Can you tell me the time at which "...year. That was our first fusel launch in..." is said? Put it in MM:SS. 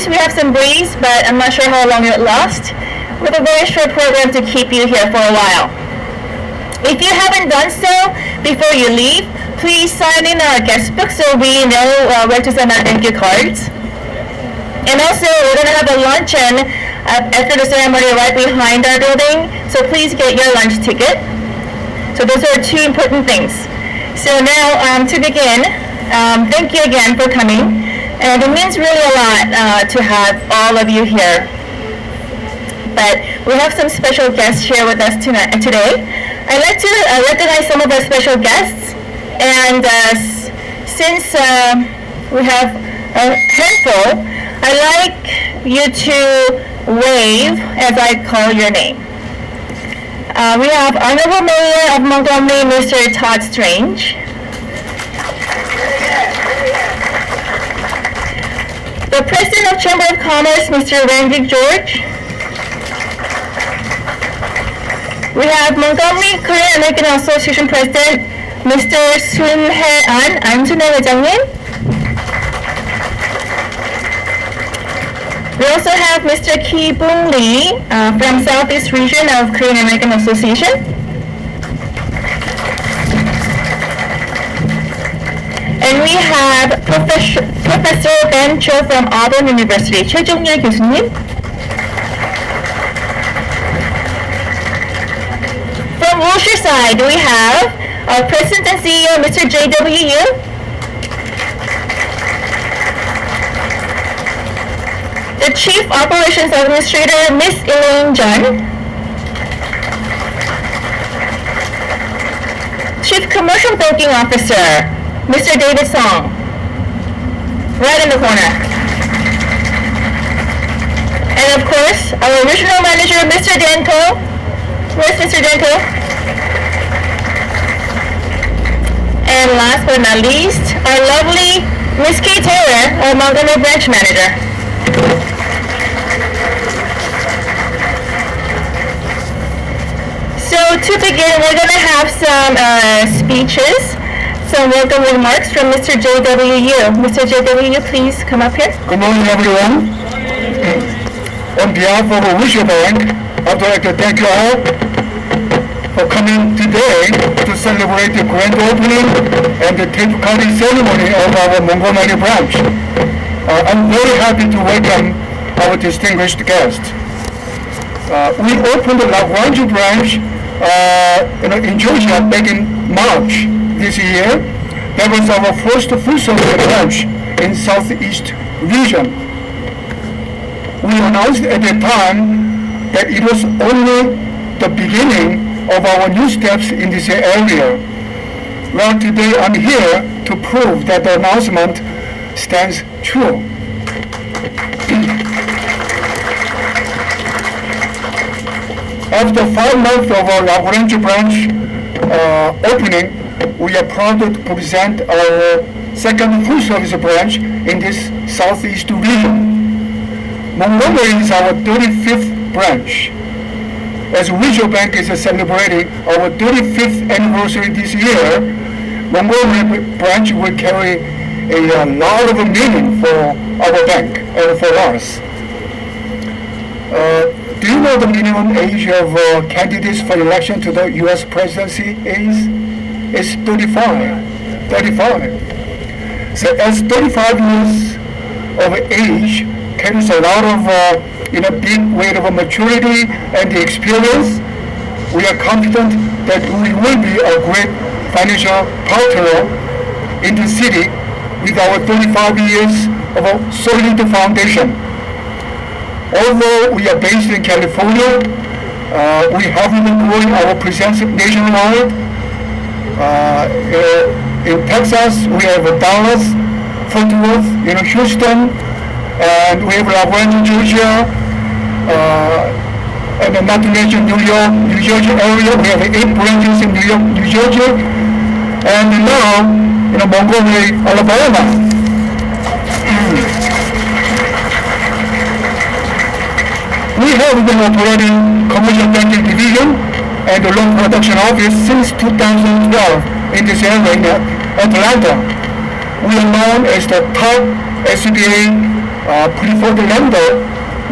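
02:53.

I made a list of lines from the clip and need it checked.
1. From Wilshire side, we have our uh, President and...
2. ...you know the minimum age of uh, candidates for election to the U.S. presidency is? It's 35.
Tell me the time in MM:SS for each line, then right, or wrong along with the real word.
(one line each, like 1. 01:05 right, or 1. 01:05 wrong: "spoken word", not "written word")
1. 01:35 right
2. 03:47 right.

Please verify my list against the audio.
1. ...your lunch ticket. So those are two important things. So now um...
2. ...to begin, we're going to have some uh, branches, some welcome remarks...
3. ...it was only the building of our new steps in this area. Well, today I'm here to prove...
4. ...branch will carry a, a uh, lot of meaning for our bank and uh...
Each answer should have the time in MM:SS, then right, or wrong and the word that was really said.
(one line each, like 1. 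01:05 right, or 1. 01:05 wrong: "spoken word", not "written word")
1. 00:20 right
2. 02:20 wrong: "speeches", not "branches"
3. 03:03 wrong: "beginning", not "building"
4. 03:39 right.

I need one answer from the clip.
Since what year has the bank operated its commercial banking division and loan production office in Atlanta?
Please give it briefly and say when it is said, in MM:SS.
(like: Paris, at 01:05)
2012, at 04:51.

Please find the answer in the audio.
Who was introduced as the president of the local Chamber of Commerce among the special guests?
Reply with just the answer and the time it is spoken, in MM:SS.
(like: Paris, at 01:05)
Randy George, at 01:00.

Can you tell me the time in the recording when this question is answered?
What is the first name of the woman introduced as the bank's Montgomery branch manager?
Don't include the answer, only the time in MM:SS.
02:12.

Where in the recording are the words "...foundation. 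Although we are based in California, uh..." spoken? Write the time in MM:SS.
04:14.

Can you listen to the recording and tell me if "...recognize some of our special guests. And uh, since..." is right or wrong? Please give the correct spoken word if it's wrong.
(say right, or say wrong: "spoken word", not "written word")
right.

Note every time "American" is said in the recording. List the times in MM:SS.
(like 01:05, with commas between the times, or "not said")
01:06, 01:19.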